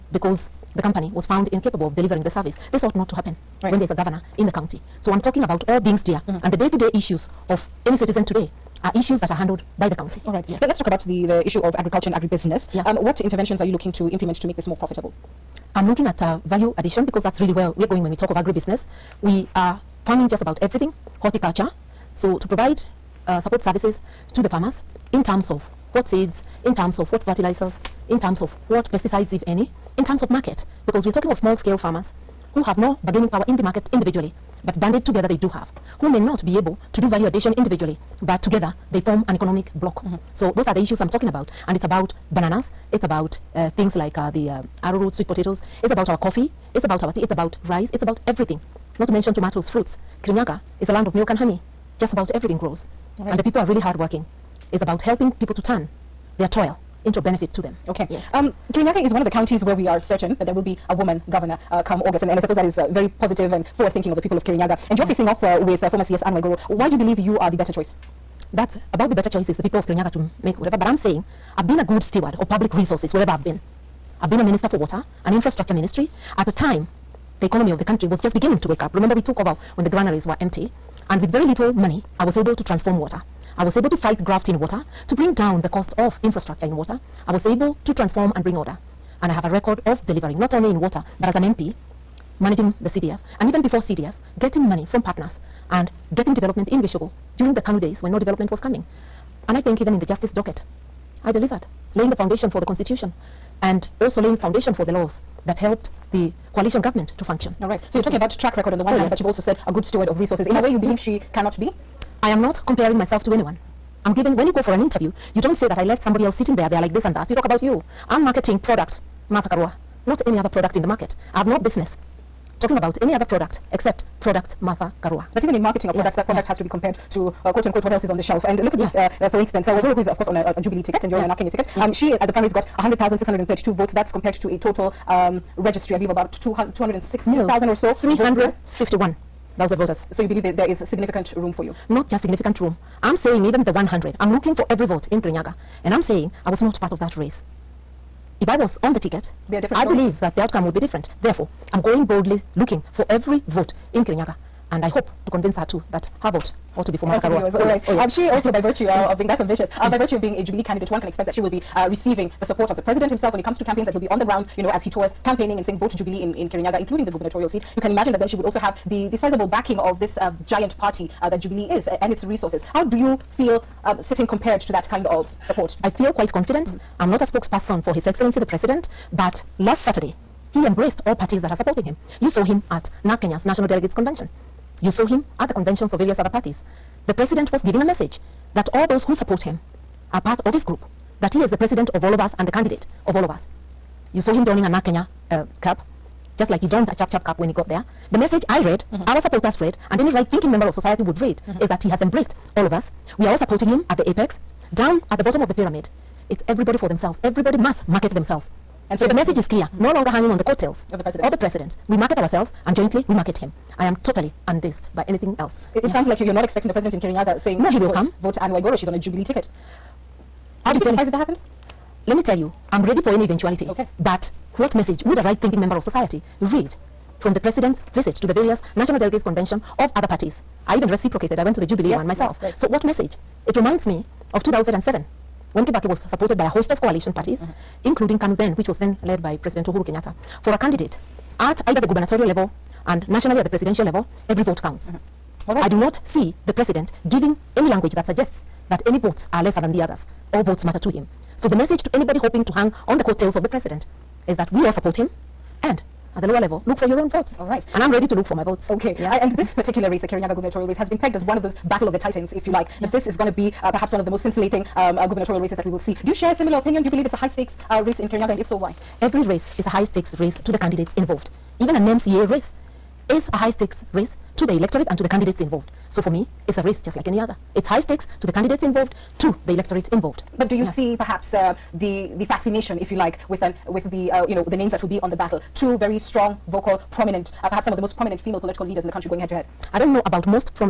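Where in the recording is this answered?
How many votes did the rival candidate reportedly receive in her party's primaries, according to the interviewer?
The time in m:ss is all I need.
2:12.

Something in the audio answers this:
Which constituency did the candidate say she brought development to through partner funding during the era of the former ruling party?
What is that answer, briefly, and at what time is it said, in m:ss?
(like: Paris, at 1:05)
Gichugu, at 1:36.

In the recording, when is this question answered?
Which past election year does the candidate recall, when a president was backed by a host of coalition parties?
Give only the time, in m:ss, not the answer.
3:54.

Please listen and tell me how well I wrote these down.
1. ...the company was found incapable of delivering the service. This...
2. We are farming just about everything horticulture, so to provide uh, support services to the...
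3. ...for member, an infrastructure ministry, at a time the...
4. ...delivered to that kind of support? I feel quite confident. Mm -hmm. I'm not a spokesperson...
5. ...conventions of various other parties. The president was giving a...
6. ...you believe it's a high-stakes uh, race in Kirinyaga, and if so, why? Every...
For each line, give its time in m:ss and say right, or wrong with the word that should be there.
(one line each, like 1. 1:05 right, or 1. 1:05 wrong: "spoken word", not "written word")
1. 0:00 right
2. 0:19 right
3. 1:14 wrong: "water", not "member"
4. 2:54 wrong: "compared", not "delivered"
5. 3:05 right
6. 4:26 right.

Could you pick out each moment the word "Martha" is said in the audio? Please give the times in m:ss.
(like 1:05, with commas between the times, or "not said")
1:59, 2:04, 2:37.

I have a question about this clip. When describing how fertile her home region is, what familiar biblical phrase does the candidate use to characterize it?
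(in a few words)
land of milk and honey.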